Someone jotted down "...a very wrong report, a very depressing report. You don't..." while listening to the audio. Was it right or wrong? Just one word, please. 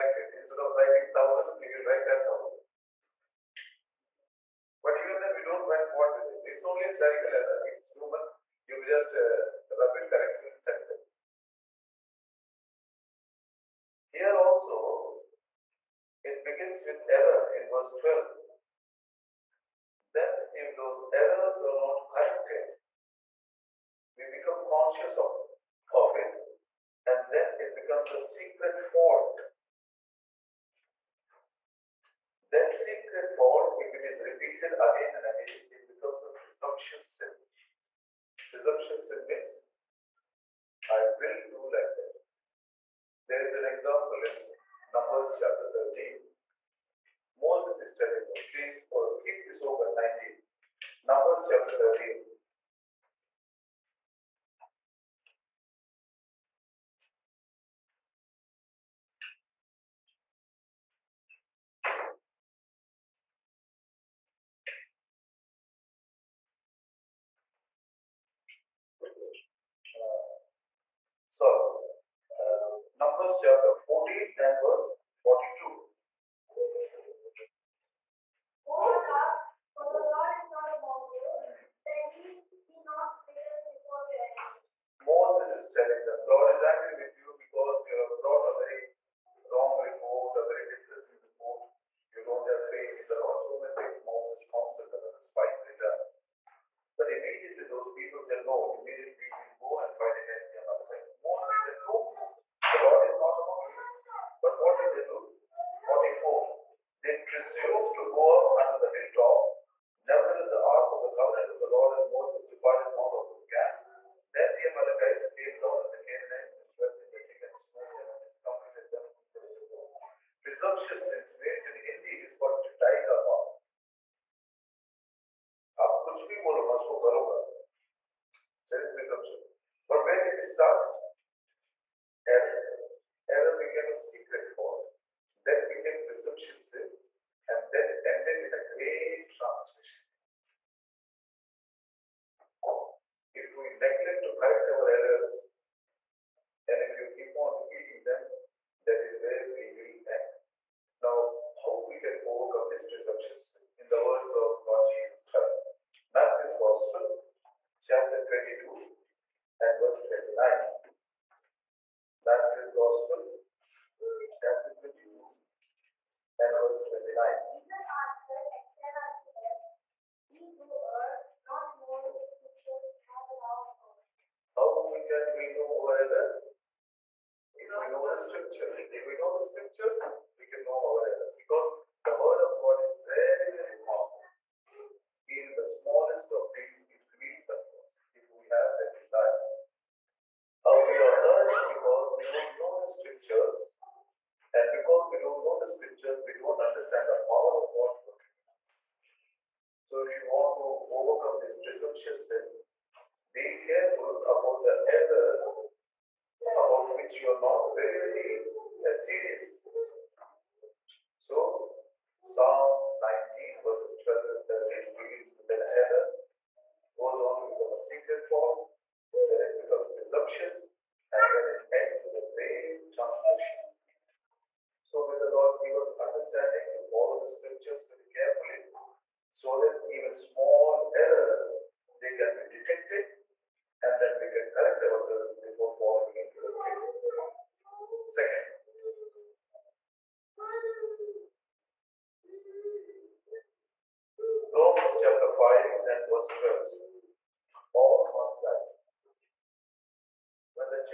right.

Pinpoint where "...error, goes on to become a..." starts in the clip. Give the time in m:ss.
3:35.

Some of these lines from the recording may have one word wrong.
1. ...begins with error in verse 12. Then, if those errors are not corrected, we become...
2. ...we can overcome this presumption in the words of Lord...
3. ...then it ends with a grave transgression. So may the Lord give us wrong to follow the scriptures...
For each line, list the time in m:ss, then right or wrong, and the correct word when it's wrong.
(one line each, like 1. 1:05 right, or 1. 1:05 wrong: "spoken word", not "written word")
1. 0:16 right
2. 2:31 right
3. 3:41 wrong: "understanding", not "wrong".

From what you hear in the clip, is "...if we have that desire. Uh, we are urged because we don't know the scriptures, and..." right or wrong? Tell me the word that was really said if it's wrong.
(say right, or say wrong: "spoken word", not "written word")
right.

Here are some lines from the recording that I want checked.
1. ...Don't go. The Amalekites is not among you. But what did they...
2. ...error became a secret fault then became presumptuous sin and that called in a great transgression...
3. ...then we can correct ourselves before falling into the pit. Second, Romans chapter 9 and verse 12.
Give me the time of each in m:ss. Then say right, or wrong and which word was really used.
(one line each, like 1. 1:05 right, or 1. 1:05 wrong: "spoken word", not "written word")
1. 1:41 wrong: "Lord", not "Amalekites"
2. 2:13 wrong: "ended", not "called"
3. 3:54 wrong: "5", not "9".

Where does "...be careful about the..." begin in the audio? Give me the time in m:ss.
3:23.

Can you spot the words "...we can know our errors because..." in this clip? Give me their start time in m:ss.
3:00.